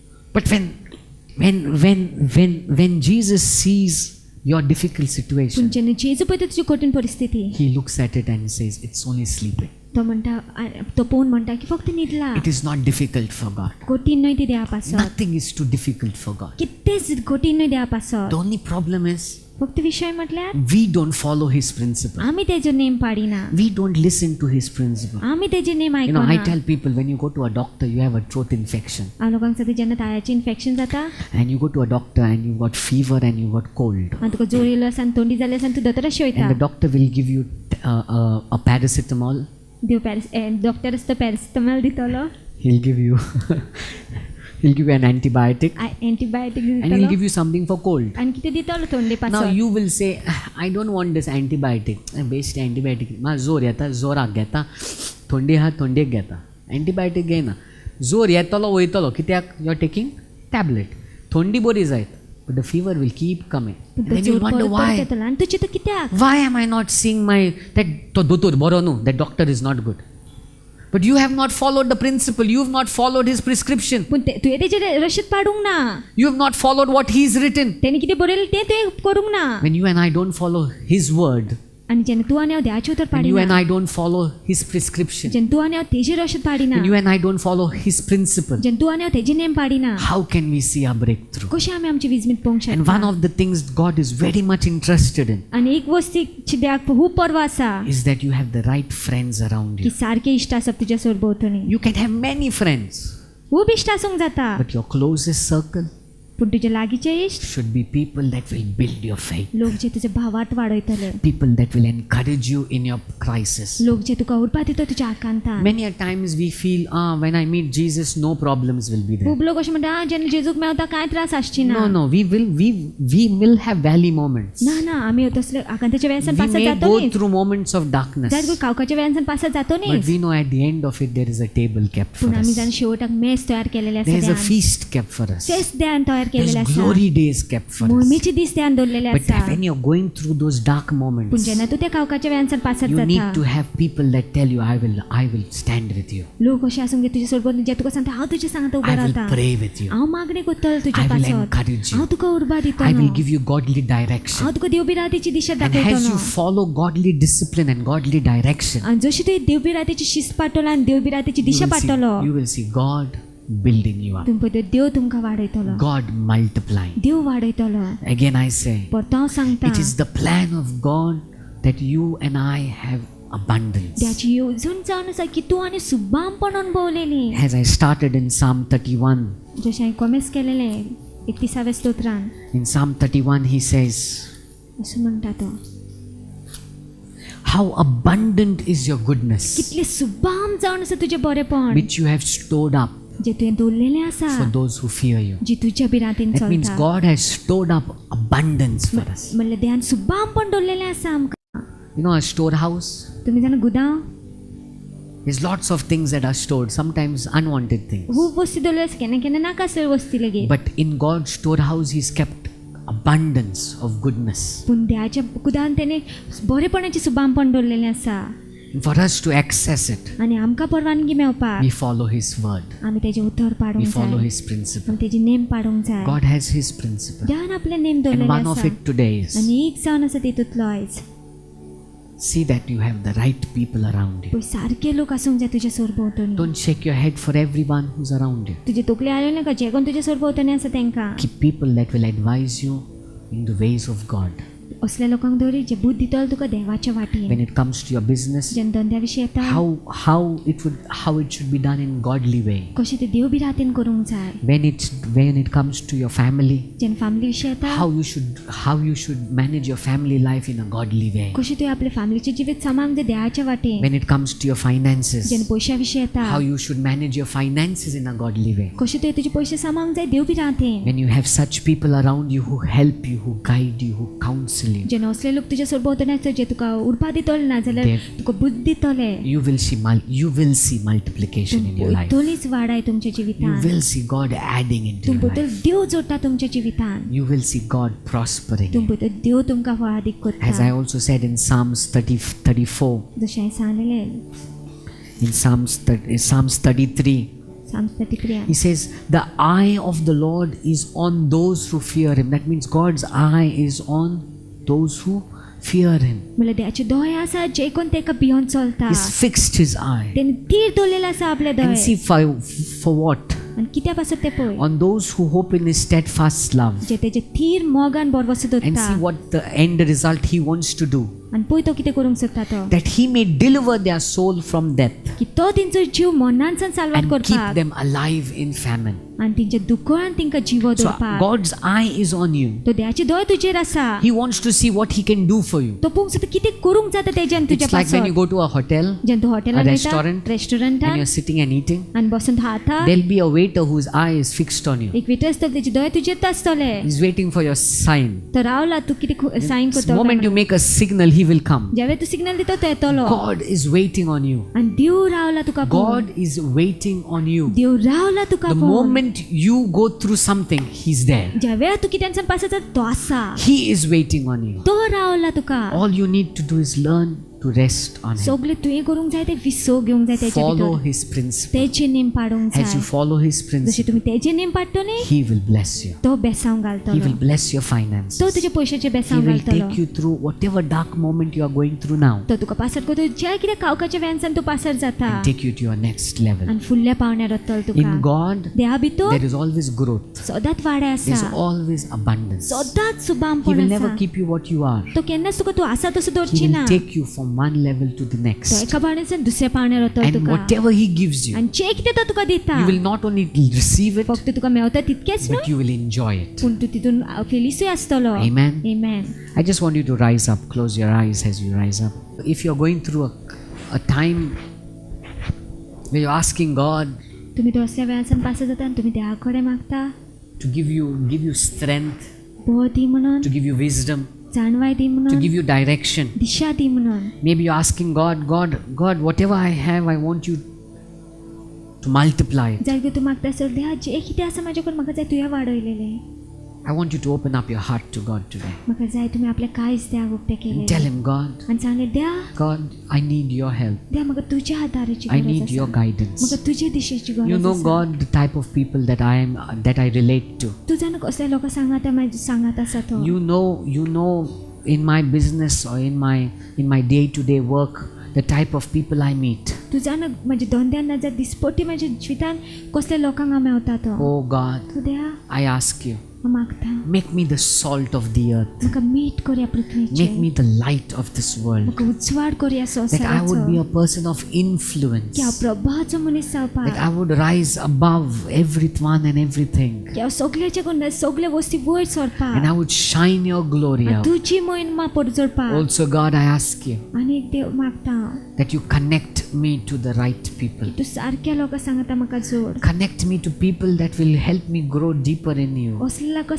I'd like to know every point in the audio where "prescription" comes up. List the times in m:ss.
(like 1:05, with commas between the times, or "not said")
1:13, 1:24.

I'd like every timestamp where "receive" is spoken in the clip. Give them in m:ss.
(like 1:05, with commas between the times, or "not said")
6:43.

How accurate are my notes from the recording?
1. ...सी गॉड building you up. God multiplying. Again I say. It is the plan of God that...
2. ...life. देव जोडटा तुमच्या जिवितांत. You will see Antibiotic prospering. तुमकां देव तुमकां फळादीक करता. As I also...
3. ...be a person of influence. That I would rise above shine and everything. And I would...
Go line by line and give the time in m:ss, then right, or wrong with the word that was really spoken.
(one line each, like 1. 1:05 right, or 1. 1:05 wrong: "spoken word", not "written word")
1. 2:42 right
2. 4:45 wrong: "God", not "Antibiotic"
3. 7:53 wrong: "everyone", not "shine".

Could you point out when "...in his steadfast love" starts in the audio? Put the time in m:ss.
5:15.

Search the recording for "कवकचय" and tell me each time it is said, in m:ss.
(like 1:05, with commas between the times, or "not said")
2:08, 2:21.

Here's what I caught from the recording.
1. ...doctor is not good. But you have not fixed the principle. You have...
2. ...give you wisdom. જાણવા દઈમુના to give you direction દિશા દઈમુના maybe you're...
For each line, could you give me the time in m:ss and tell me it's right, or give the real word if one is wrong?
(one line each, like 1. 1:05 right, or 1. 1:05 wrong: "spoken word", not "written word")
1. 1:09 wrong: "followed", not "fixed"
2. 7:03 right.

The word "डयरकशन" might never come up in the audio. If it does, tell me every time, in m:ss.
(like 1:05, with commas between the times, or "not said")
2:33, 2:38.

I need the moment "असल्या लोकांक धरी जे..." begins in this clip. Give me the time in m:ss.
4:04.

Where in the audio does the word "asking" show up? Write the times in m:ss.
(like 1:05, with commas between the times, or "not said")
6:56, 7:07.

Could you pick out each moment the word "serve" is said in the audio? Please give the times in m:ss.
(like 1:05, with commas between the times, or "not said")
not said.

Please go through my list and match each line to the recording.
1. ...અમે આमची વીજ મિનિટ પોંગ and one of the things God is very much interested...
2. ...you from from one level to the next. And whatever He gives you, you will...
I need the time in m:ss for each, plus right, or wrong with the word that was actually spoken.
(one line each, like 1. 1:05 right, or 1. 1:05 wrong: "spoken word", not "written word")
1. 1:31 right
2. 6:36 right.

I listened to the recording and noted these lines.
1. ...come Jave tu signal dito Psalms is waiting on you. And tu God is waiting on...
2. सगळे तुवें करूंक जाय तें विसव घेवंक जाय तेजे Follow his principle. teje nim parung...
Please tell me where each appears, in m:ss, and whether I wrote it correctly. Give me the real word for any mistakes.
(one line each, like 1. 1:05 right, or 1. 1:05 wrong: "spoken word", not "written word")
1. 5:51 wrong: "God", not "Psalms"
2. 6:08 right.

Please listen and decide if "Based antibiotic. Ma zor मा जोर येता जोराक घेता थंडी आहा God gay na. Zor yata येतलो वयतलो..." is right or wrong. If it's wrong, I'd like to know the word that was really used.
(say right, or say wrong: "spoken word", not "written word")
wrong: "Antibiotic", not "God".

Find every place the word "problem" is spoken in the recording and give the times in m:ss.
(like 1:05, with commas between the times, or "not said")
0:18, 1:58.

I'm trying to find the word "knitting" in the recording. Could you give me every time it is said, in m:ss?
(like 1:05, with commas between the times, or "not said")
not said.